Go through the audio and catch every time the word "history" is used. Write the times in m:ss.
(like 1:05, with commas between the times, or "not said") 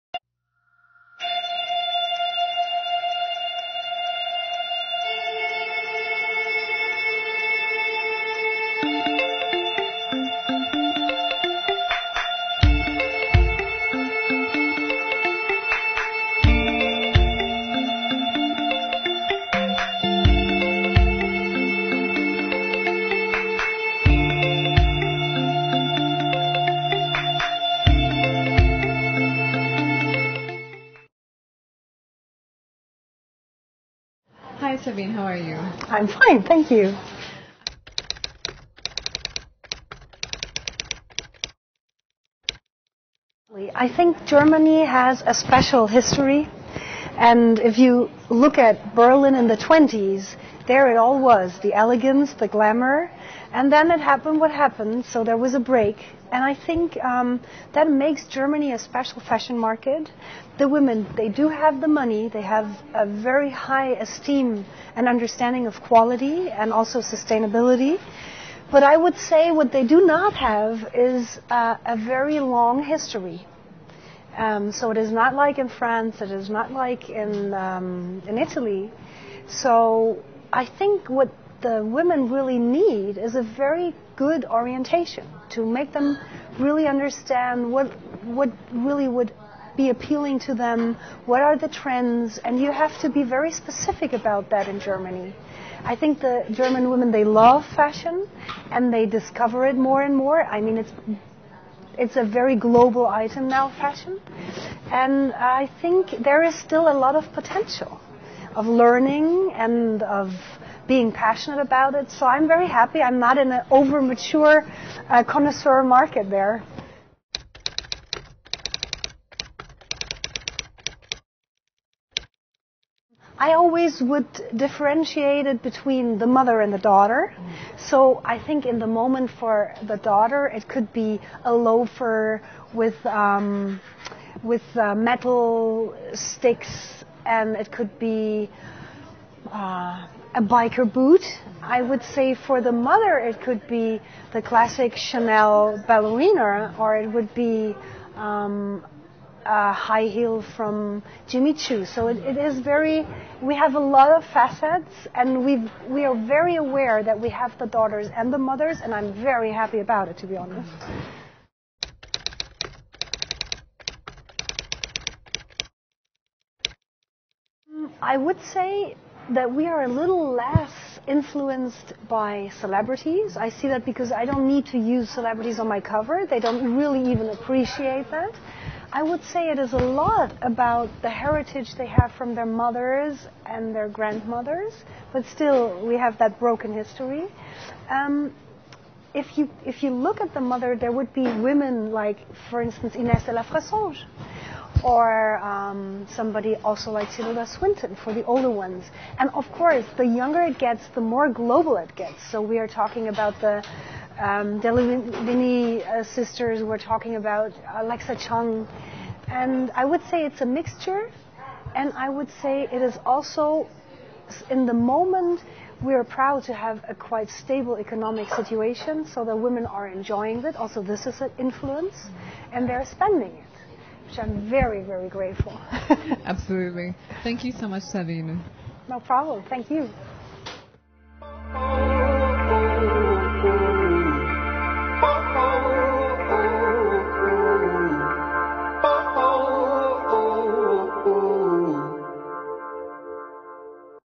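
0:45, 1:12, 3:06.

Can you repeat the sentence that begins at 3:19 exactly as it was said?
And of course, the younger it gets, the more global it gets.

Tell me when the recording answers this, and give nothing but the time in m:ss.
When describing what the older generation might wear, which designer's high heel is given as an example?
2:31.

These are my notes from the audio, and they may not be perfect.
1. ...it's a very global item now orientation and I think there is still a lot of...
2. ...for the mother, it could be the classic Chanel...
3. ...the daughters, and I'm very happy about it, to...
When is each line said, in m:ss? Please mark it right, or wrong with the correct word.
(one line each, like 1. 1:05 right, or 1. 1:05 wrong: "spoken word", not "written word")
1. 1:41 wrong: "fashion", not "orientation"
2. 2:22 right
3. 2:38 wrong: "mothers", not "daughters".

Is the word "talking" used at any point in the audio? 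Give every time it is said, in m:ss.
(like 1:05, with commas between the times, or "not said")
3:22, 3:26.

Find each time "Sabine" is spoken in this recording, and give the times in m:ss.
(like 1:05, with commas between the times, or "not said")
0:34, 3:47.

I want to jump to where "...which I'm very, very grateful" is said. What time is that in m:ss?
3:44.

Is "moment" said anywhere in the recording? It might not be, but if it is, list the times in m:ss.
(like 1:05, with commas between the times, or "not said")
2:08, 3:34.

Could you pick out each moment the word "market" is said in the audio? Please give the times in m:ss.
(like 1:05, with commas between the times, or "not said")
0:59, 1:55.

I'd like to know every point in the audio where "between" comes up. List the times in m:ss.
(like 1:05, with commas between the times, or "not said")
2:05.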